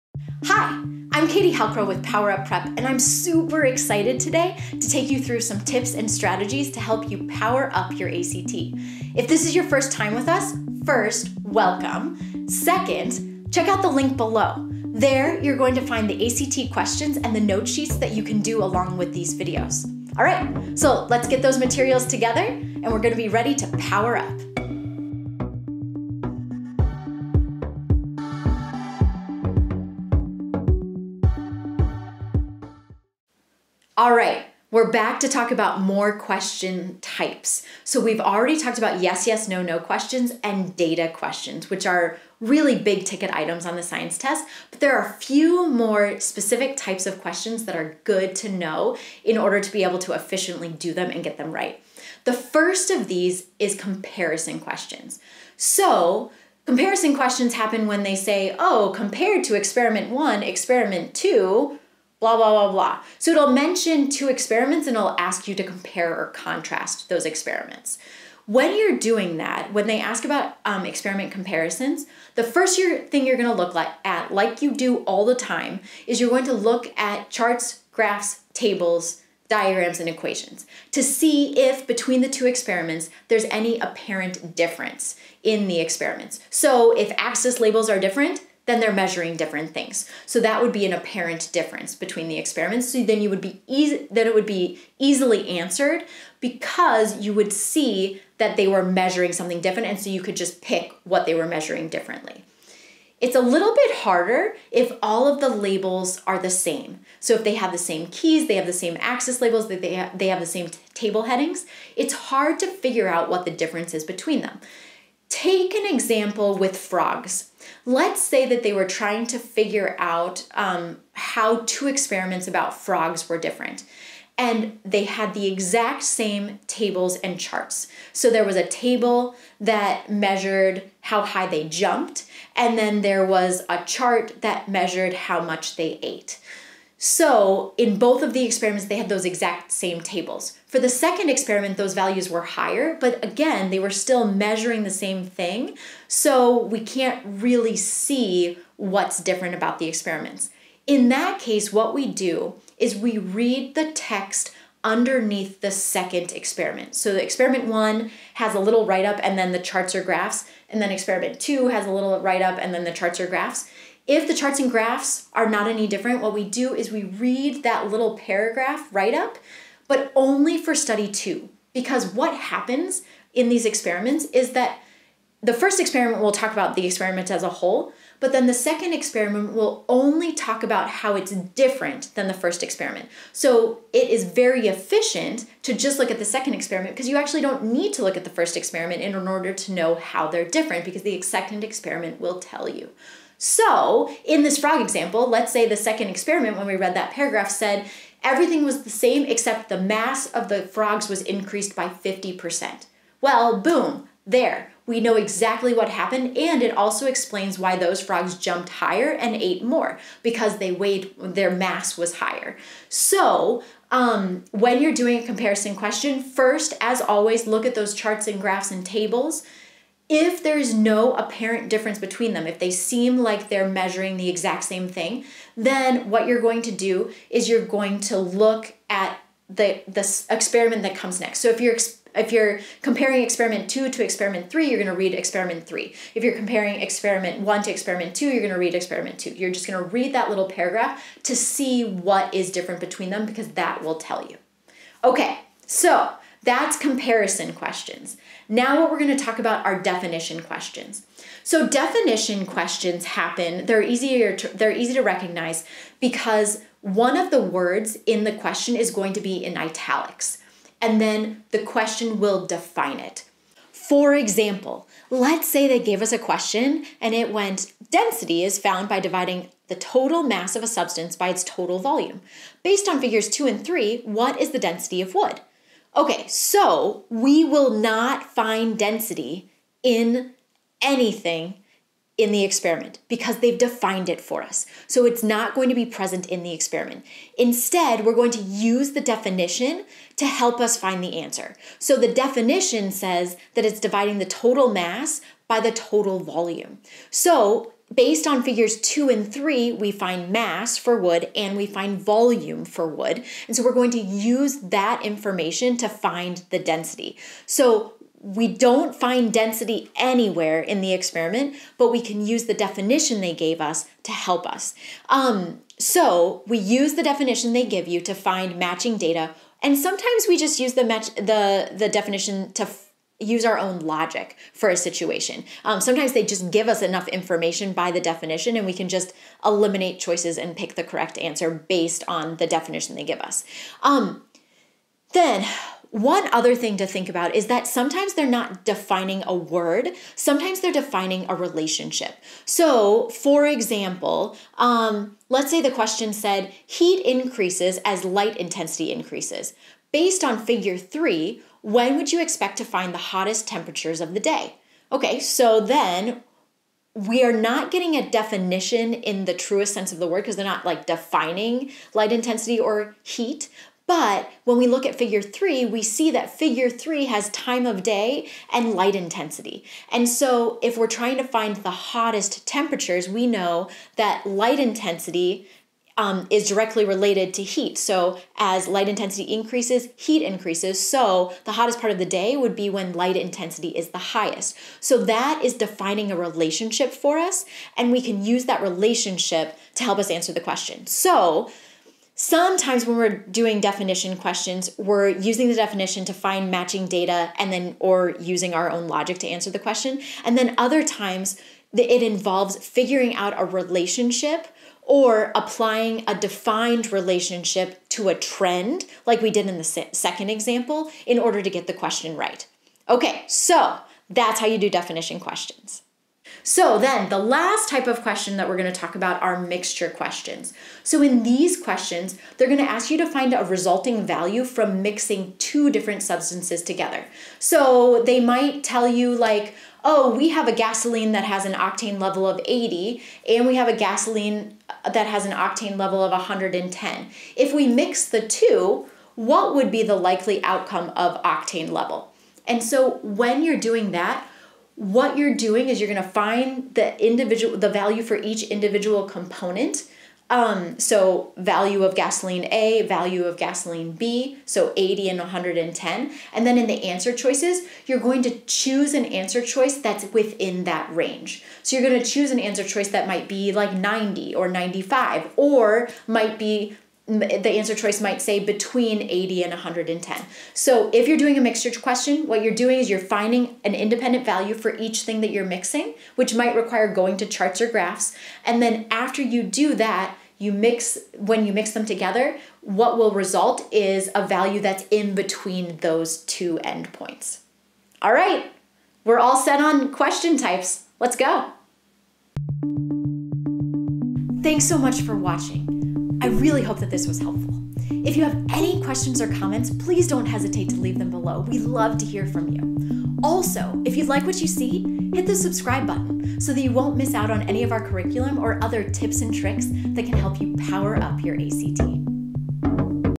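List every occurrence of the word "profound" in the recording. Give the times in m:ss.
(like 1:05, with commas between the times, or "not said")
not said.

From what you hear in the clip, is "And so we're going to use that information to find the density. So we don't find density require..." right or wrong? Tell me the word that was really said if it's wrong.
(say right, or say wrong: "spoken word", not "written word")
wrong: "anywhere", not "require".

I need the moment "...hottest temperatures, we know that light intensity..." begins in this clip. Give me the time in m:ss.
6:11.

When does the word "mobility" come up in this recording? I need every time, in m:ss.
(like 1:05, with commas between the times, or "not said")
not said.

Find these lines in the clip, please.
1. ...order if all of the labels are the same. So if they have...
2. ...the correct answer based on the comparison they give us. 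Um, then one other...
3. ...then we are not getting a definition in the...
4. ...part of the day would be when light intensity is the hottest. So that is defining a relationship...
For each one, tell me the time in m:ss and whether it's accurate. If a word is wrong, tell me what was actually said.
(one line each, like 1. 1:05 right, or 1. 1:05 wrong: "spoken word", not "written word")
1. 1:43 wrong: "harder", not "order"
2. 5:30 wrong: "definition", not "comparison"
3. 5:55 right
4. 6:21 wrong: "highest", not "hottest".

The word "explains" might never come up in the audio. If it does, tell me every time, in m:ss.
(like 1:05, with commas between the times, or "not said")
3:27.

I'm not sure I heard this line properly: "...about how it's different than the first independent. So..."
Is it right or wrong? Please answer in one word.
wrong.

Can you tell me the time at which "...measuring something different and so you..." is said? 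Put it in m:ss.
1:38.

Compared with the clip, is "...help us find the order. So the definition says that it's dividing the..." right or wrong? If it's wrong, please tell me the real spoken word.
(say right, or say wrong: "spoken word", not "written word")
wrong: "answer", not "order".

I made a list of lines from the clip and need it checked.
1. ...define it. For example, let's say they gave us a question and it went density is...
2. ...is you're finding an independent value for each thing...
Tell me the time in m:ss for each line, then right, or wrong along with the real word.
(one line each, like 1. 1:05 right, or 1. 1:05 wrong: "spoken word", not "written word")
1. 4:22 right
2. 7:52 right.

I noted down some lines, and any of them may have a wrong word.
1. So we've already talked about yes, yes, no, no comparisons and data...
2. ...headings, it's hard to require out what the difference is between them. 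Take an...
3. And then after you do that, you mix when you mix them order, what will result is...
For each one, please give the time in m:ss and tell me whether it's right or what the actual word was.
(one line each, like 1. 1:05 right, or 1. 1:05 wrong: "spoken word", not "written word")
1. 0:37 wrong: "questions", not "comparisons"
2. 1:51 wrong: "figure", not "require"
3. 7:58 wrong: "together", not "order".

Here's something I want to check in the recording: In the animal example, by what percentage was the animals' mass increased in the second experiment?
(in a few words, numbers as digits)
50%.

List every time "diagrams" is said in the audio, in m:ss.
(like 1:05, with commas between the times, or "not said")
1:19.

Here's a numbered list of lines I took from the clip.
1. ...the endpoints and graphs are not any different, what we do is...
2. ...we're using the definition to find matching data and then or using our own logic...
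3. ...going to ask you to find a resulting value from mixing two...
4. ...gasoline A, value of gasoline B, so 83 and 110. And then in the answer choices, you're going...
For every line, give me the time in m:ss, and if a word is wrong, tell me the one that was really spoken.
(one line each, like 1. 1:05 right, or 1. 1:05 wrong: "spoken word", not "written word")
1. 2:44 wrong: "charts", not "endpoints"
2. 6:34 right
3. 7:02 right
4. 7:31 wrong: "80", not "83".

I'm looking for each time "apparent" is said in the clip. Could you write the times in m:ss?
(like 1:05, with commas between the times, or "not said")
1:23, 1:30, 3:41.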